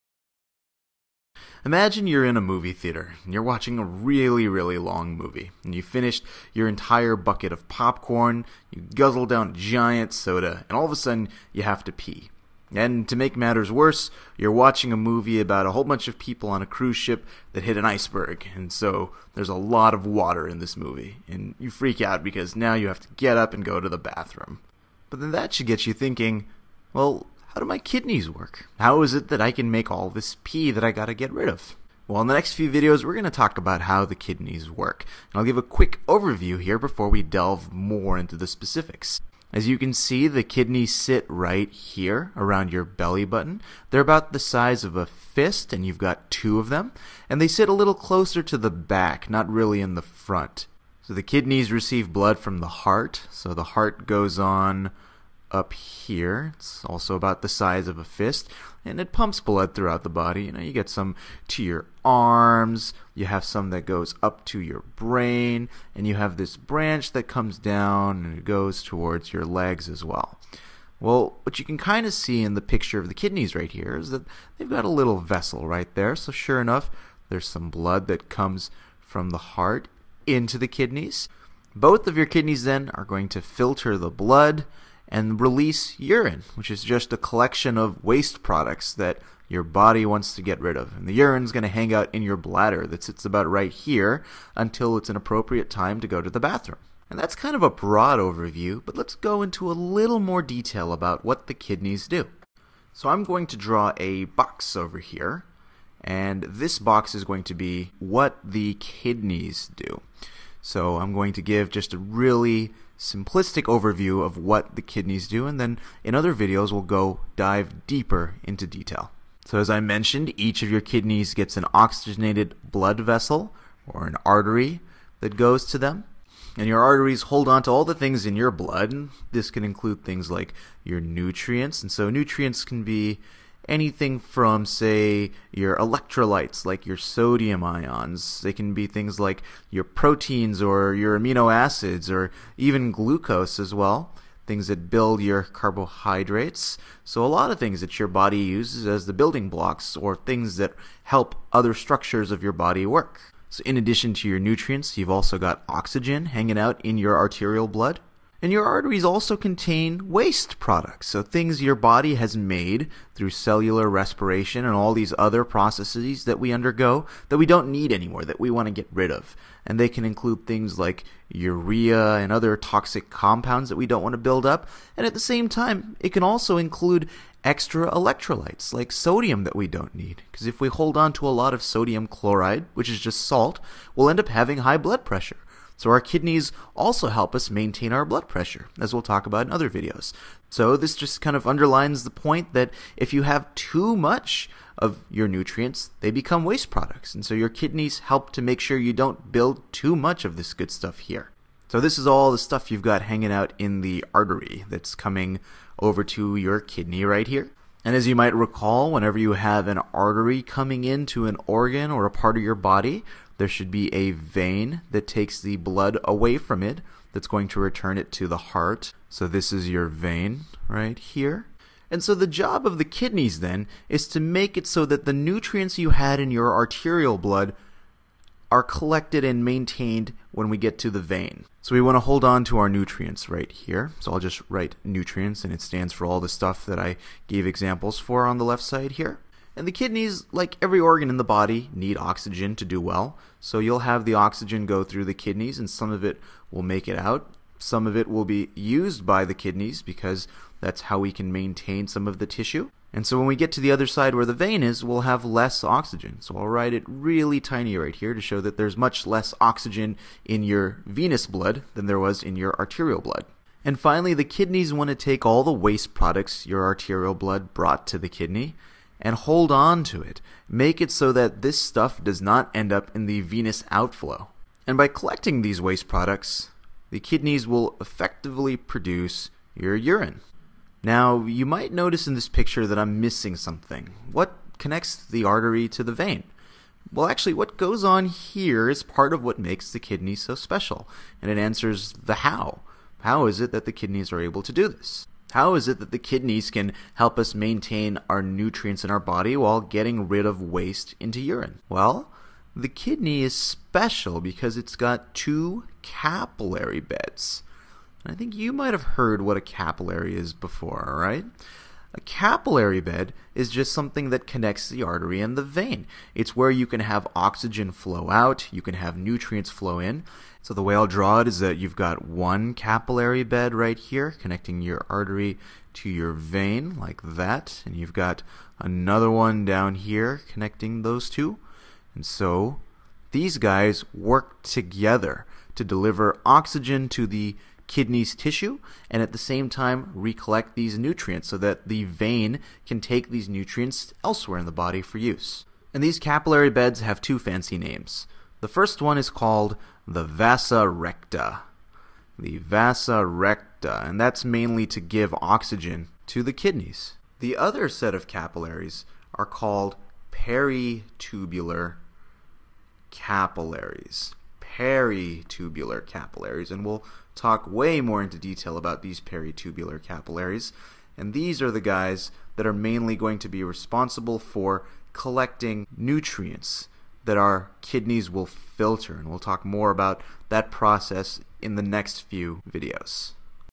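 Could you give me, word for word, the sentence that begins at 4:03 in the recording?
So you'll have the oxygen go through the kidneys, and some of it will make it out.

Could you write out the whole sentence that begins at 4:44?
What connects the artery to the vein?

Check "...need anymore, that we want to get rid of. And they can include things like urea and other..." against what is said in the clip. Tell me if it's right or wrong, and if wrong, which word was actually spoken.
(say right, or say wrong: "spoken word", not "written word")
right.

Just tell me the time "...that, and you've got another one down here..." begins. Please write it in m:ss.
5:27.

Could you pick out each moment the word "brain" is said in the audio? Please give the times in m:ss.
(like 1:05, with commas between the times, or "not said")
1:04.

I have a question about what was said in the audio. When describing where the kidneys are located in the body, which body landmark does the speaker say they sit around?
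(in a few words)
belly button.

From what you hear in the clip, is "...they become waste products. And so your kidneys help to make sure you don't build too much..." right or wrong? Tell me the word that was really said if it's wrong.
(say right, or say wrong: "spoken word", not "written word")
right.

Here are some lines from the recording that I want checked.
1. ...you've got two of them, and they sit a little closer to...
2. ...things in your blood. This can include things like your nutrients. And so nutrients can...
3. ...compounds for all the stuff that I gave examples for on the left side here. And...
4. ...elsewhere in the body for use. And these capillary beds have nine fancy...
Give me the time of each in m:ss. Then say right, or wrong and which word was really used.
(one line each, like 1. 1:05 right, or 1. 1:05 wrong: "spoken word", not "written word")
1. 0:45 right
2. 2:07 right
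3. 3:55 wrong: "stands", not "compounds"
4. 5:44 wrong: "two", not "nine".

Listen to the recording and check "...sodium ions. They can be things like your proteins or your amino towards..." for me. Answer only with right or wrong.
wrong.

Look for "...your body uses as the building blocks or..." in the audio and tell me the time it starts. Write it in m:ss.
2:27.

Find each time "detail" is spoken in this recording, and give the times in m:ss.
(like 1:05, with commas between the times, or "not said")
1:40, 1:58, 6:08.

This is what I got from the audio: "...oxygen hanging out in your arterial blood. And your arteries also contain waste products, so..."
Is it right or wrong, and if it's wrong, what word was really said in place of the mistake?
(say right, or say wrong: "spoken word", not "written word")
right.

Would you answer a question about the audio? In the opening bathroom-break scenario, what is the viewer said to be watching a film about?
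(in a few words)
cruise ship that hit an iceberg.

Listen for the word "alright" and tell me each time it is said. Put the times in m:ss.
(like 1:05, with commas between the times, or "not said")
not said.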